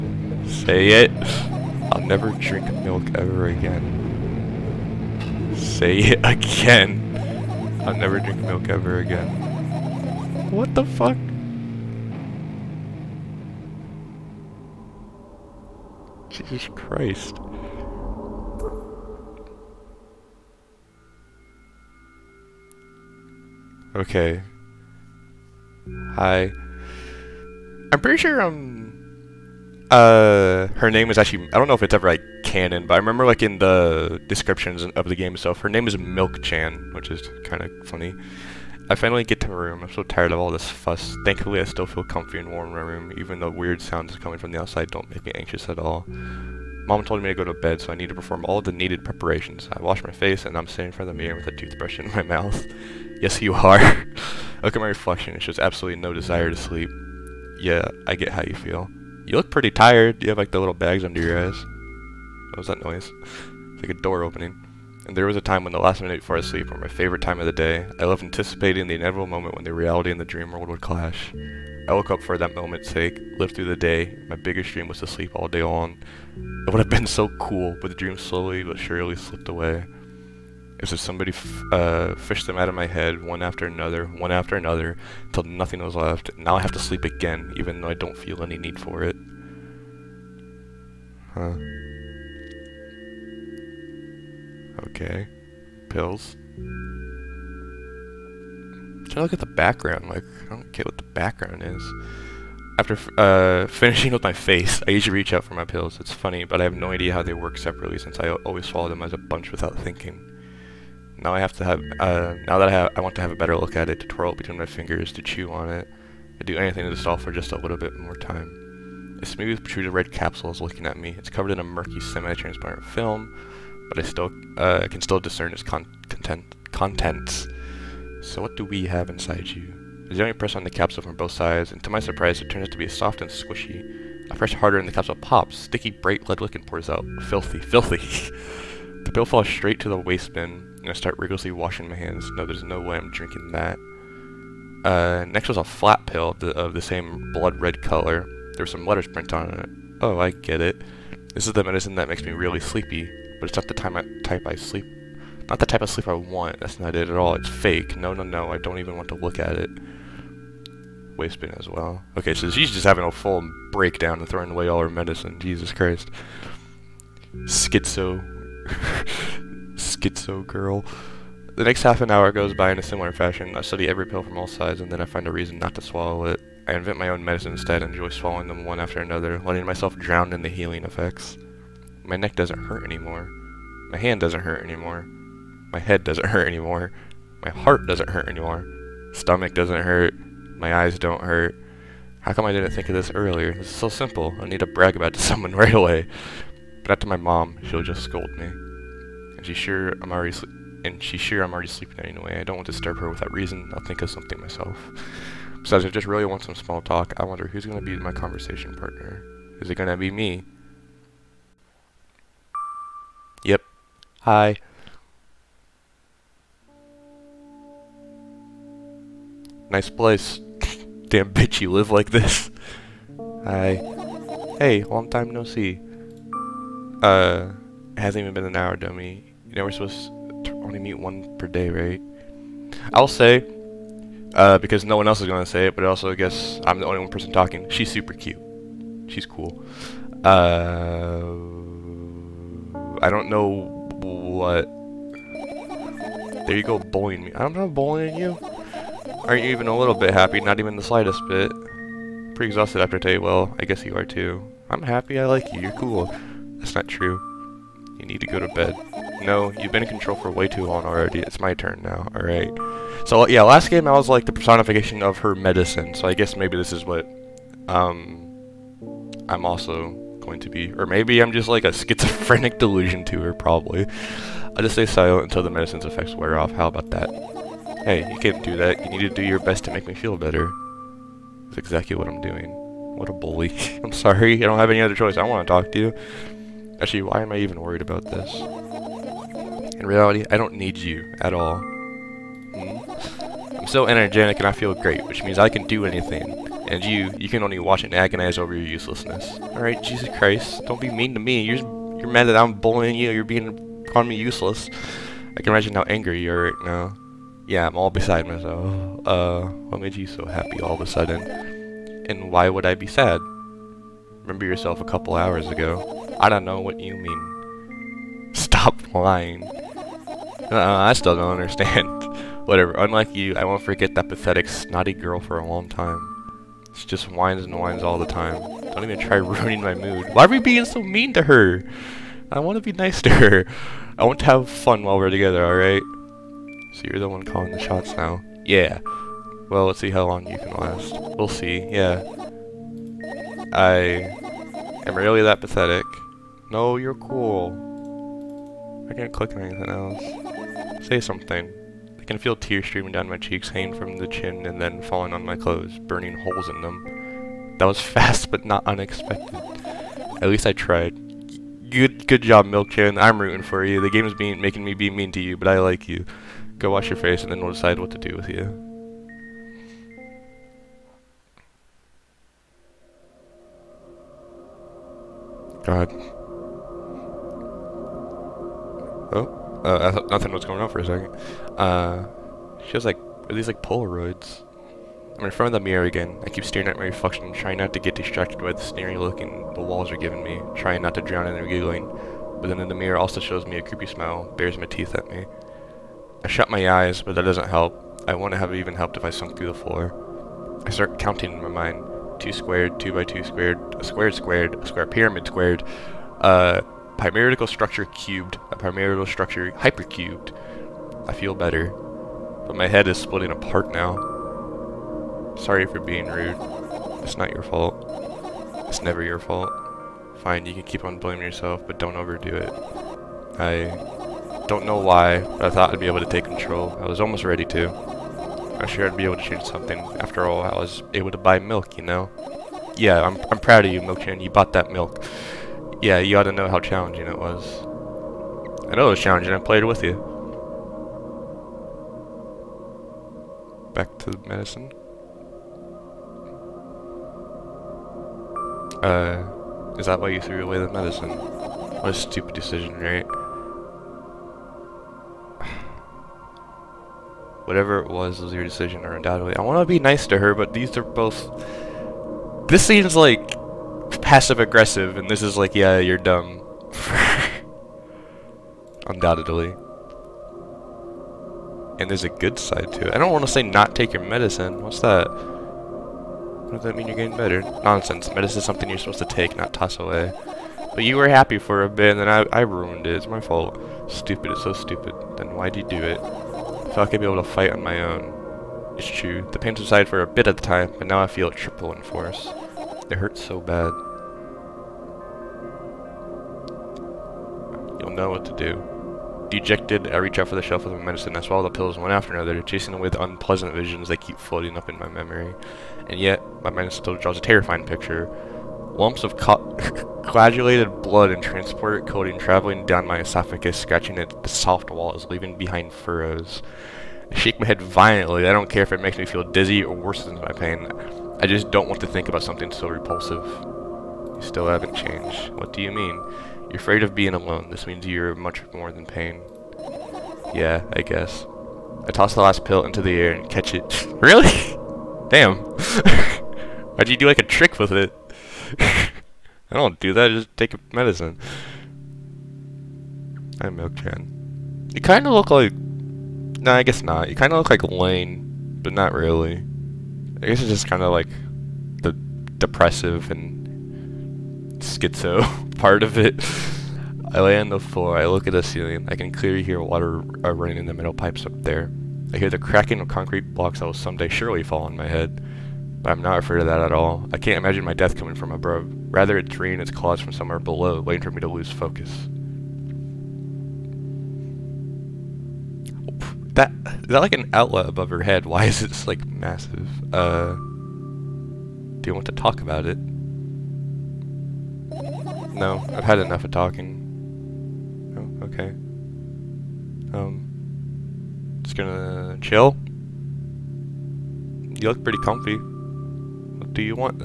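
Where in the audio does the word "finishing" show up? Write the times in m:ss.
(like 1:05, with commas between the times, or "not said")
1:43.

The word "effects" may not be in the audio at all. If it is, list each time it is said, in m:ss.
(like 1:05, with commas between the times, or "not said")
3:00, 4:35.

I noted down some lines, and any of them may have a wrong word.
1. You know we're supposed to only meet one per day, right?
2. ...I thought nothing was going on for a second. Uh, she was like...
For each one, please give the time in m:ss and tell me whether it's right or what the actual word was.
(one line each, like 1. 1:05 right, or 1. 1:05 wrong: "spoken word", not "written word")
1. 3:49 right
2. 6:19 right.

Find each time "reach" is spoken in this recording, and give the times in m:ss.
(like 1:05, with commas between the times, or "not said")
1:45, 8:19.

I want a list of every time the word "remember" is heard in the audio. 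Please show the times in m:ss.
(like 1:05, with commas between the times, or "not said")
0:32, 5:14.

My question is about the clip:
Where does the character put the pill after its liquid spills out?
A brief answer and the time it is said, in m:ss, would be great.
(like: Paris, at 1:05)
the waste bin, at 2:19.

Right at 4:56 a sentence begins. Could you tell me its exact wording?
And you, you can only watch and agonize over your uselessness.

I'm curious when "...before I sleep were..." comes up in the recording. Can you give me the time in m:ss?
1:06.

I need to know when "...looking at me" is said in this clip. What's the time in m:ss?
2:00.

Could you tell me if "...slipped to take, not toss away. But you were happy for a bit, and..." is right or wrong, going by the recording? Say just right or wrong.
wrong.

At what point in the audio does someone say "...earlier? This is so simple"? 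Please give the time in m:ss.
3:13.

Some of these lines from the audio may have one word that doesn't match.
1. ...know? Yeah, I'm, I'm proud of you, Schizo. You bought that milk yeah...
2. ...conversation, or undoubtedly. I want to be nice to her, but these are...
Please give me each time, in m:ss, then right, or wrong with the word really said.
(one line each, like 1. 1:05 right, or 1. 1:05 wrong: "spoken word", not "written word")
1. 7:11 wrong: "Milkman", not "Schizo"
2. 7:38 wrong: "decision", not "conversation".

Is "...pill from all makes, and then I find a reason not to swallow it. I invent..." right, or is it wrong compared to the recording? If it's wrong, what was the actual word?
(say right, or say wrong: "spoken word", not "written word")
wrong: "sides", not "makes".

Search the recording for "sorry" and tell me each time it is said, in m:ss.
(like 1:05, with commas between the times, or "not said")
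4:43, 6:55.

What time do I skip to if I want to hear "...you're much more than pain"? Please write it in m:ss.
8:47.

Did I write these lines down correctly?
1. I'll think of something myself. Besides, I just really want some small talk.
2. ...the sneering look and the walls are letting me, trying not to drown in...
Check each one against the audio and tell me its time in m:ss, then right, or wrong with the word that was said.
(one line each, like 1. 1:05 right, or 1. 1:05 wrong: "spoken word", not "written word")
1. 3:23 right
2. 6:28 wrong: "giving", not "letting".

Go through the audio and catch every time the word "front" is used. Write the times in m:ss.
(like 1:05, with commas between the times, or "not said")
0:50, 6:25.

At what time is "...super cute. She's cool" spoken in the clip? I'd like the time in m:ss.
3:57.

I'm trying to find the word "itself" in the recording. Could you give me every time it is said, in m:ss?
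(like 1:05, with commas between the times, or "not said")
0:35.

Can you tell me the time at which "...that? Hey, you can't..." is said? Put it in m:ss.
4:36.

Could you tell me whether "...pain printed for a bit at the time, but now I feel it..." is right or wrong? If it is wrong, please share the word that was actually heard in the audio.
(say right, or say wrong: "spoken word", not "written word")
wrong: "subsided", not "printed".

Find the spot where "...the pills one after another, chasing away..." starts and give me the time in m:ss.
8:21.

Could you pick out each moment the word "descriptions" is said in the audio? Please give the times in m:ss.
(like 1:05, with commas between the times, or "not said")
0:34.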